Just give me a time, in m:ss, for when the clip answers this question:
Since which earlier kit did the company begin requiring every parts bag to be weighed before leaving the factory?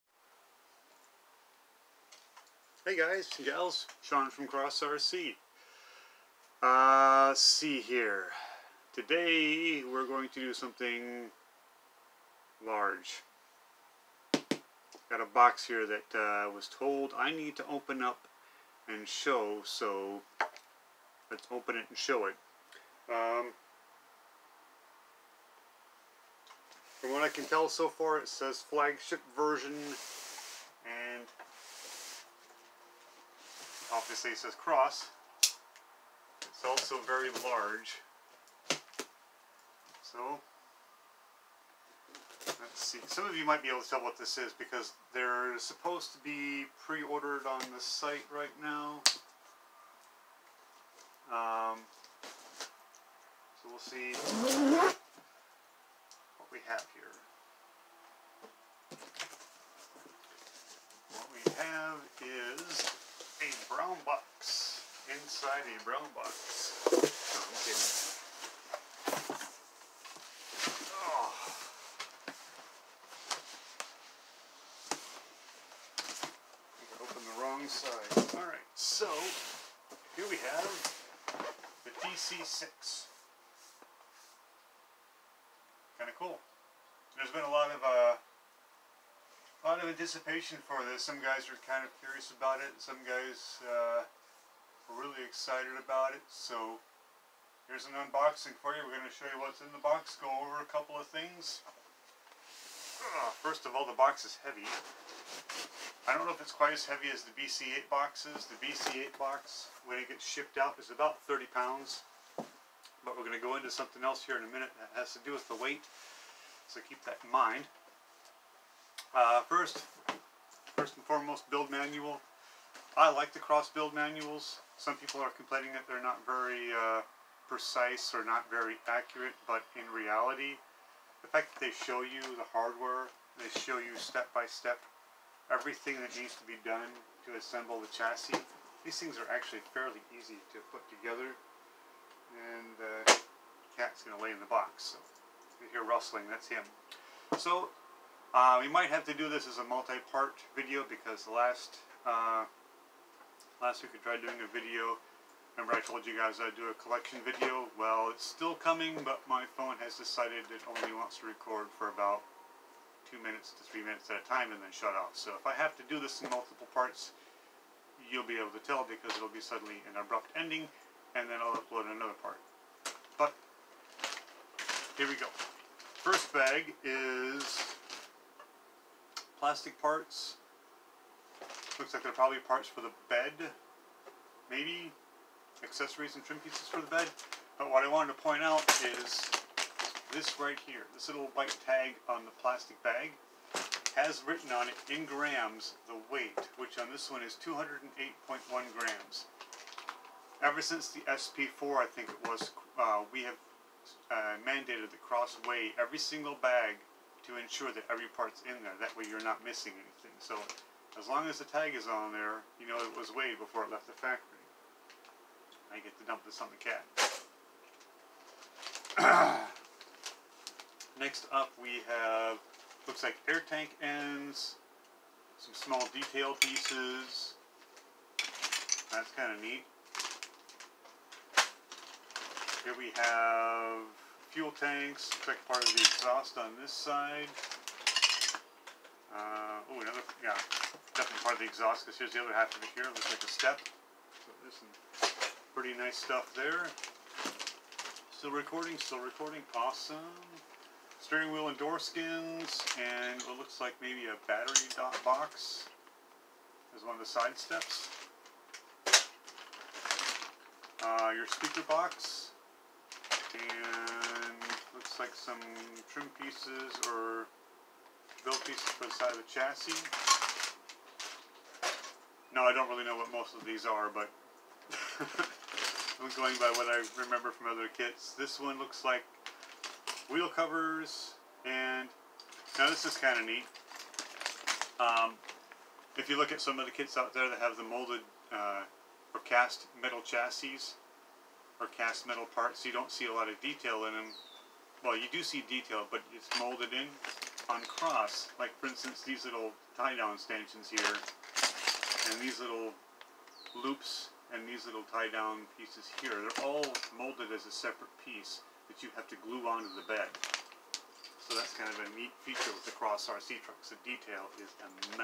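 3:21.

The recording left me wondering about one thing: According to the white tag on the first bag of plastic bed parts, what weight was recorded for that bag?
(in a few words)
208.1 grams.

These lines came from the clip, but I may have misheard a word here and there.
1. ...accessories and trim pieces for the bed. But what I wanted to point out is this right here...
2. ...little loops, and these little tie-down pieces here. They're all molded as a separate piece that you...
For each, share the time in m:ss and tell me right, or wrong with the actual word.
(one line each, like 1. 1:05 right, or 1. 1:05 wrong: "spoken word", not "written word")
1. 3:05 right
2. 5:02 right.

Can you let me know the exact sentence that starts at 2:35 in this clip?
Remember I told you guys I'd do a collection video?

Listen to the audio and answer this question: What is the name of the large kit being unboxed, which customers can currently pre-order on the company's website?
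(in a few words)
TC-6.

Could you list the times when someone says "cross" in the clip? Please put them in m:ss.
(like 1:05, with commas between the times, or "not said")
0:04, 0:34, 2:03, 3:25, 4:57, 5:12.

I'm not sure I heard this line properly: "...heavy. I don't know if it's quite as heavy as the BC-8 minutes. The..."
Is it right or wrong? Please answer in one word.
wrong.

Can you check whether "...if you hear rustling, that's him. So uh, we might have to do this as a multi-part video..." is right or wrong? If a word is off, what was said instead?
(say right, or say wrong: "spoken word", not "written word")
right.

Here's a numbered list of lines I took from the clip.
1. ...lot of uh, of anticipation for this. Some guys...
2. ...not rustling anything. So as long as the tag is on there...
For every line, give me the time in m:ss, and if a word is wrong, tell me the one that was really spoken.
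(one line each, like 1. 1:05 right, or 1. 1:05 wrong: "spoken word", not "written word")
1. 1:27 right
2. 3:29 wrong: "missing", not "rustling".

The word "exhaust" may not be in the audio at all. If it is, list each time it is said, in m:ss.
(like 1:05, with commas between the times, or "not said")
3:55, 4:01.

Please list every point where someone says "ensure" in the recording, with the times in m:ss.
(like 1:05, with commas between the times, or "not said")
3:27.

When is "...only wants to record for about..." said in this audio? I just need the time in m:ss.
2:40.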